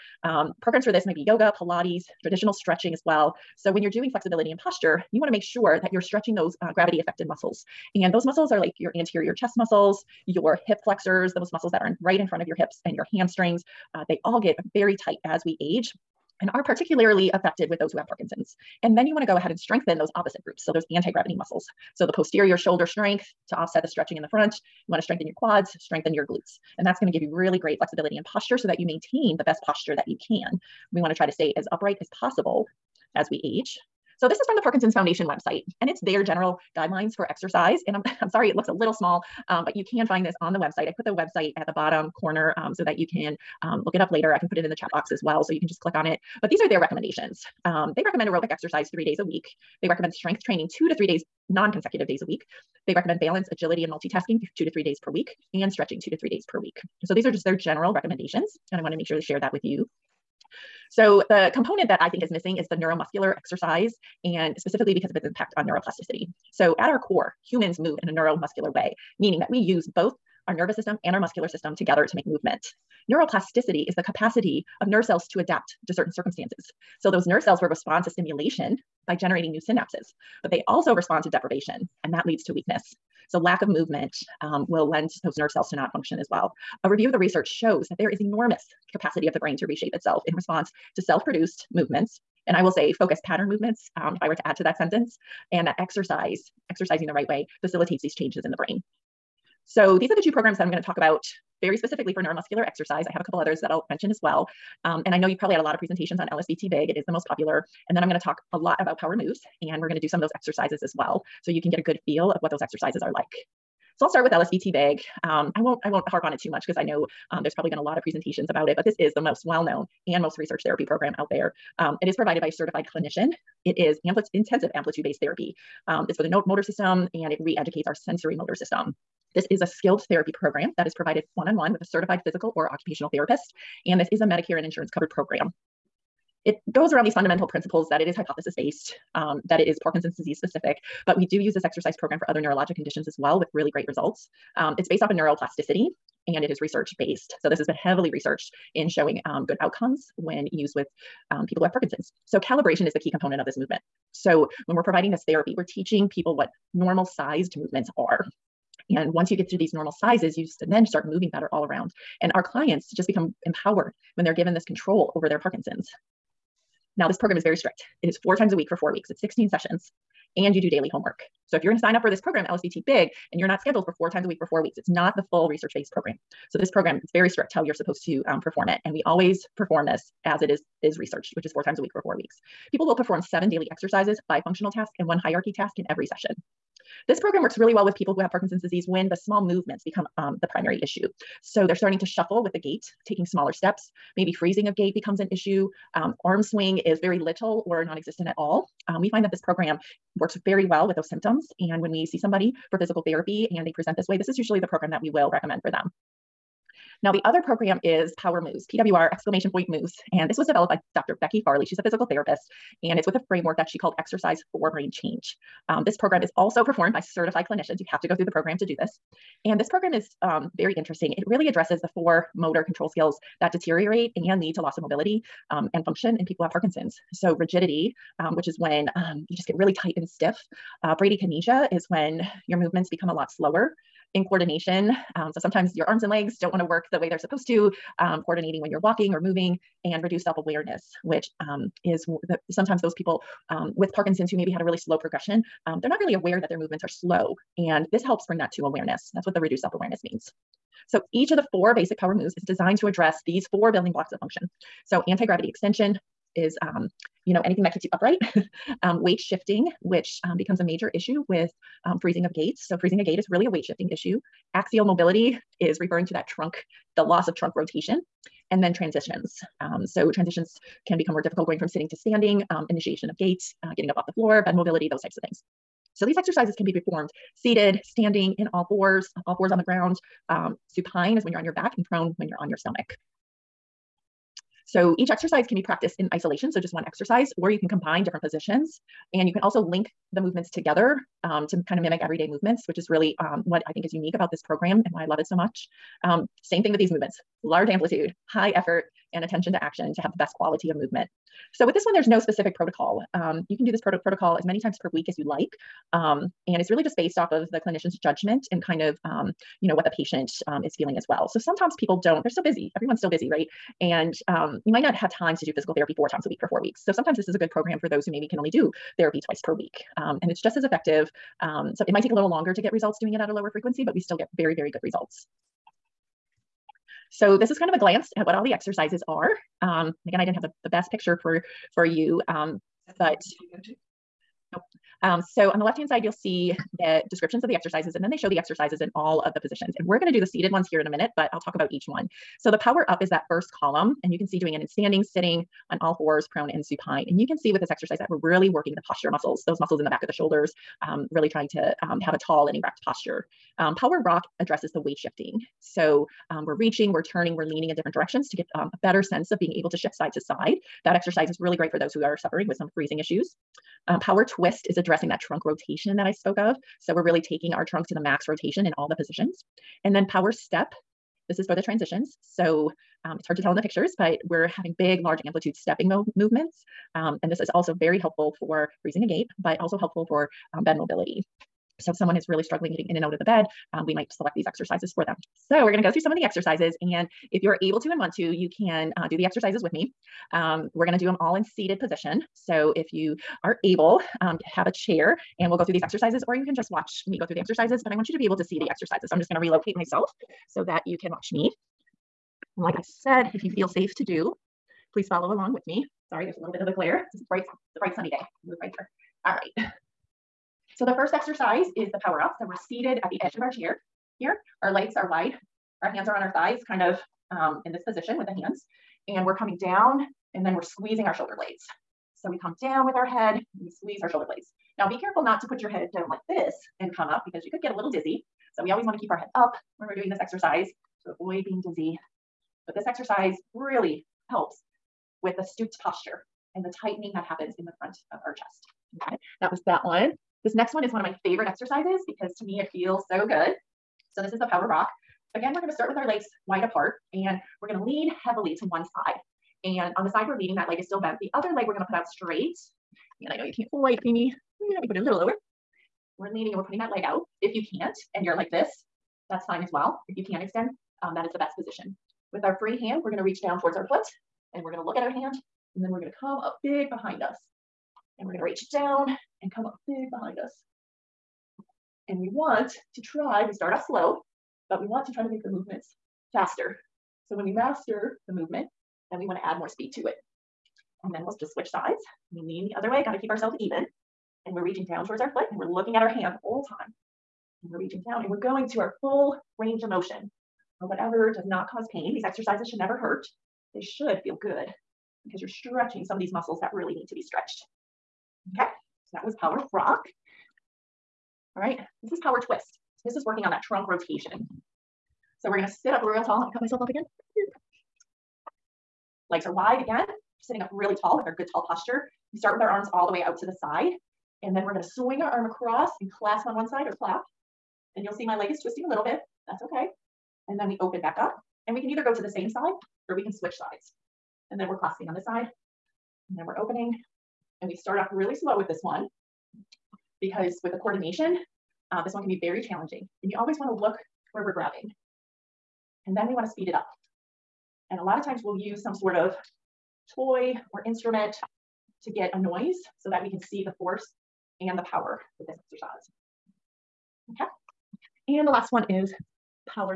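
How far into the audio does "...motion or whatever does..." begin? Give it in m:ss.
8:09.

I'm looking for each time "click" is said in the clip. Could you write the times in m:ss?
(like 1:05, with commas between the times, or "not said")
0:45.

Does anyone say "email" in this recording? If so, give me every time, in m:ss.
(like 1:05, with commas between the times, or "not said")
not said.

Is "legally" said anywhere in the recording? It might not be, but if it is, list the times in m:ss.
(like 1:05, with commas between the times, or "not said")
not said.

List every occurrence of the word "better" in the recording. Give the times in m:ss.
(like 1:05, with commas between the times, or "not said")
2:41, 5:58.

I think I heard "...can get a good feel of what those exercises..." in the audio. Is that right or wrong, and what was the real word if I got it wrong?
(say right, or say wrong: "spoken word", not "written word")
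right.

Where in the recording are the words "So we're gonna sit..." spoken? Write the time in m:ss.
8:25.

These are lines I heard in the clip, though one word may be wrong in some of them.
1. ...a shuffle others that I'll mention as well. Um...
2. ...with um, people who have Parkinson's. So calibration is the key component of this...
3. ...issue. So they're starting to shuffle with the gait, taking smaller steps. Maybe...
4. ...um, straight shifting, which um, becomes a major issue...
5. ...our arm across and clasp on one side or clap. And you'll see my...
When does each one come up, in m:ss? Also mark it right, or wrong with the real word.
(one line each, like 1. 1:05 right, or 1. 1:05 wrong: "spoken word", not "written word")
1. 1:43 wrong: "couple", not "shuffle"
2. 2:30 right
3. 3:10 right
4. 4:18 wrong: "weight", not "straight"
5. 8:35 right.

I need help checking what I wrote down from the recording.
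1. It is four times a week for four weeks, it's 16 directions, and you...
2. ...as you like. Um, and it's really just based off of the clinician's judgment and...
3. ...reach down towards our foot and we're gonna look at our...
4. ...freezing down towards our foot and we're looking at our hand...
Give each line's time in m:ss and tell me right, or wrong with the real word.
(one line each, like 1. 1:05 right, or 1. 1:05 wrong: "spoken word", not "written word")
1. 2:48 wrong: "sessions", not "directions"
2. 5:05 right
3. 7:43 right
4. 8:04 wrong: "reaching", not "freezing".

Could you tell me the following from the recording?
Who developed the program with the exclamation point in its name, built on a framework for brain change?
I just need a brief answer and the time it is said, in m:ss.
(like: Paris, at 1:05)
Dr. Becky Farley, at 3:30.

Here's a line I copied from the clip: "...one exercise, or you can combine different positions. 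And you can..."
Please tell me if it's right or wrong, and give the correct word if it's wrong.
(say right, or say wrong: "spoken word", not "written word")
right.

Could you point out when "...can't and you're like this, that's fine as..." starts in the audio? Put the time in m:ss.
7:37.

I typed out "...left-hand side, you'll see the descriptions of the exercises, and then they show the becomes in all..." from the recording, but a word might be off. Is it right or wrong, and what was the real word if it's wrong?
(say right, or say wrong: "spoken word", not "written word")
wrong: "exercises", not "becomes".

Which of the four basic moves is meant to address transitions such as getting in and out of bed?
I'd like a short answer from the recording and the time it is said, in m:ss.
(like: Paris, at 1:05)
Power step, at 6:10.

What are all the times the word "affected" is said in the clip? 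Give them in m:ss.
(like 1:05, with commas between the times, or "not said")
0:06, 0:17.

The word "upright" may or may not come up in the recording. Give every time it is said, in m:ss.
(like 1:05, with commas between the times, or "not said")
0:31, 4:17.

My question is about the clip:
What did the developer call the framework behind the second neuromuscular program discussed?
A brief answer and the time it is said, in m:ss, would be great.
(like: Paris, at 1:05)
Exercise for Brain Change, at 3:33.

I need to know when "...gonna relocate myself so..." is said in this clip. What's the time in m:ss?
6:39.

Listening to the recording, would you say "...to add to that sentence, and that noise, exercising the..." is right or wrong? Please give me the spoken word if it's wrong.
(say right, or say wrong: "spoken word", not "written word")
wrong: "exercise", not "noise".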